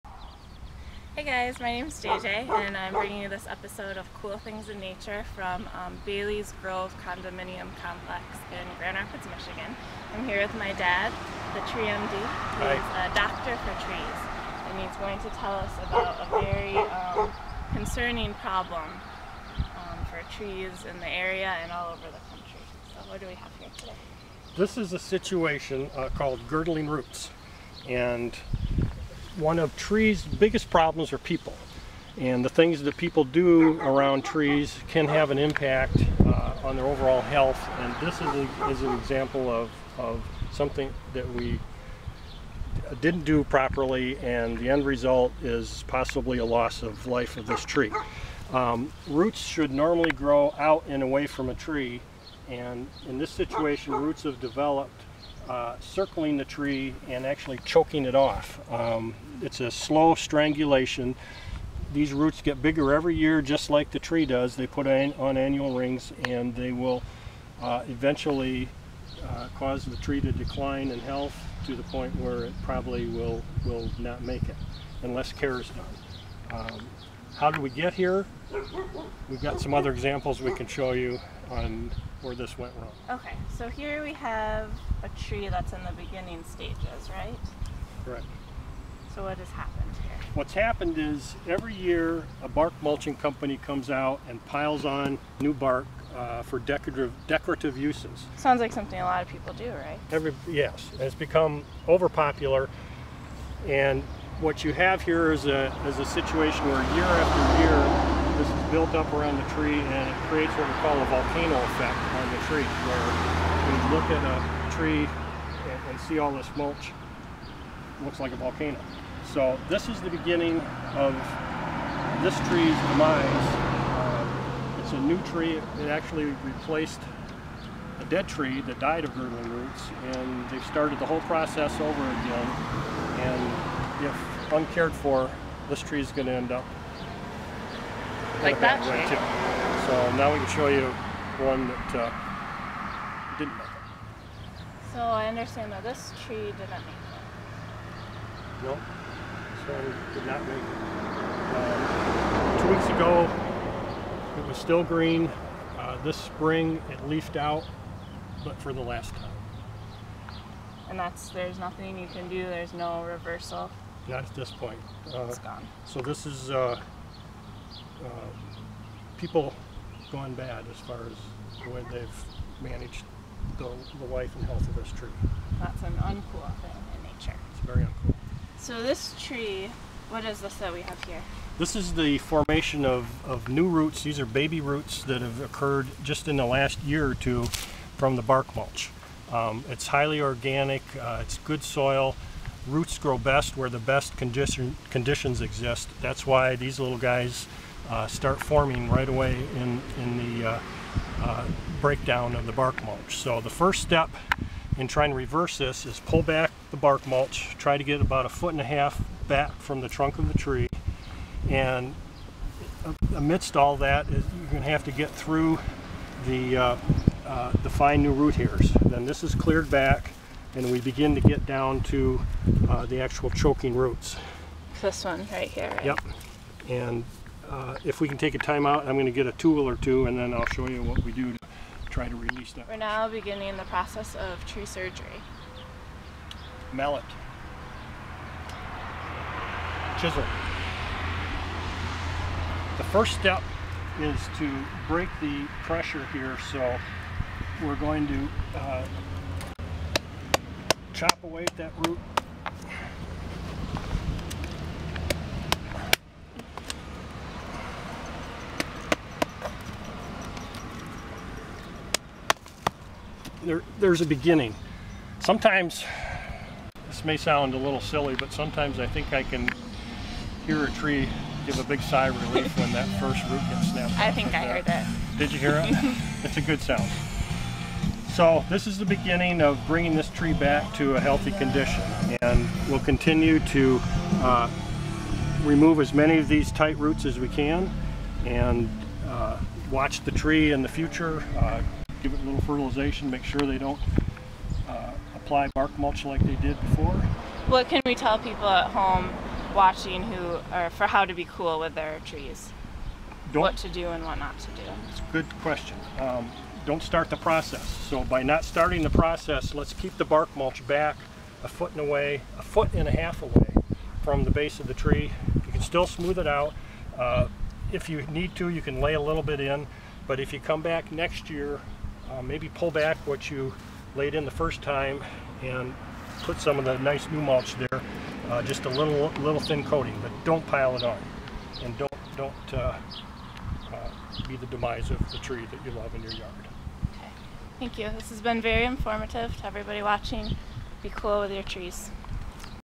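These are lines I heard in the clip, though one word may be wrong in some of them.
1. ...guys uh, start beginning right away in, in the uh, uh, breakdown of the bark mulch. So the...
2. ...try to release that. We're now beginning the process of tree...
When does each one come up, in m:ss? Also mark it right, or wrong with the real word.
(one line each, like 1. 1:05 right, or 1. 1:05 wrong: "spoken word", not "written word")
1. 3:16 wrong: "forming", not "beginning"
2. 3:51 right.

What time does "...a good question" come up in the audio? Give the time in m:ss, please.
5:04.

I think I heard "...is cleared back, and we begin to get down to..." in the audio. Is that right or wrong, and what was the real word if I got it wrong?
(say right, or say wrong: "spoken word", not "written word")
right.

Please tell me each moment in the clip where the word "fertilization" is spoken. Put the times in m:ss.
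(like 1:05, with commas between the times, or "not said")
4:52.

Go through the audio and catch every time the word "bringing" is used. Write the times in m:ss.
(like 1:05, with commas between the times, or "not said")
0:02, 4:39.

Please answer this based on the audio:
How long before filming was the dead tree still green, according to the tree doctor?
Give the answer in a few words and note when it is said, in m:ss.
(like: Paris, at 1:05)
two weeks, at 2:32.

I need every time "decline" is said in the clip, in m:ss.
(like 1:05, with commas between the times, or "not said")
1:10.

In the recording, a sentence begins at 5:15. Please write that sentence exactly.
You can still smooth it out.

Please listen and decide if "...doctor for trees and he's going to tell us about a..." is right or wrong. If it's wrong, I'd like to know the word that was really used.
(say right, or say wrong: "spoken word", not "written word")
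right.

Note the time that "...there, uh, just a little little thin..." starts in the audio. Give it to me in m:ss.
5:27.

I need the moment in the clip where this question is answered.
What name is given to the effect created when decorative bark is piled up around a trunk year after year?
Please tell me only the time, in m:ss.
1:51.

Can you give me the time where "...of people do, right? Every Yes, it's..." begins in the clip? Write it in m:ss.
1:39.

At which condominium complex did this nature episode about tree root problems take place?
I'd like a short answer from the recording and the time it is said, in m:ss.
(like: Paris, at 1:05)
Bailey's Grove, at 0:06.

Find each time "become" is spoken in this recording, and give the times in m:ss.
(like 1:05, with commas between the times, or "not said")
1:41.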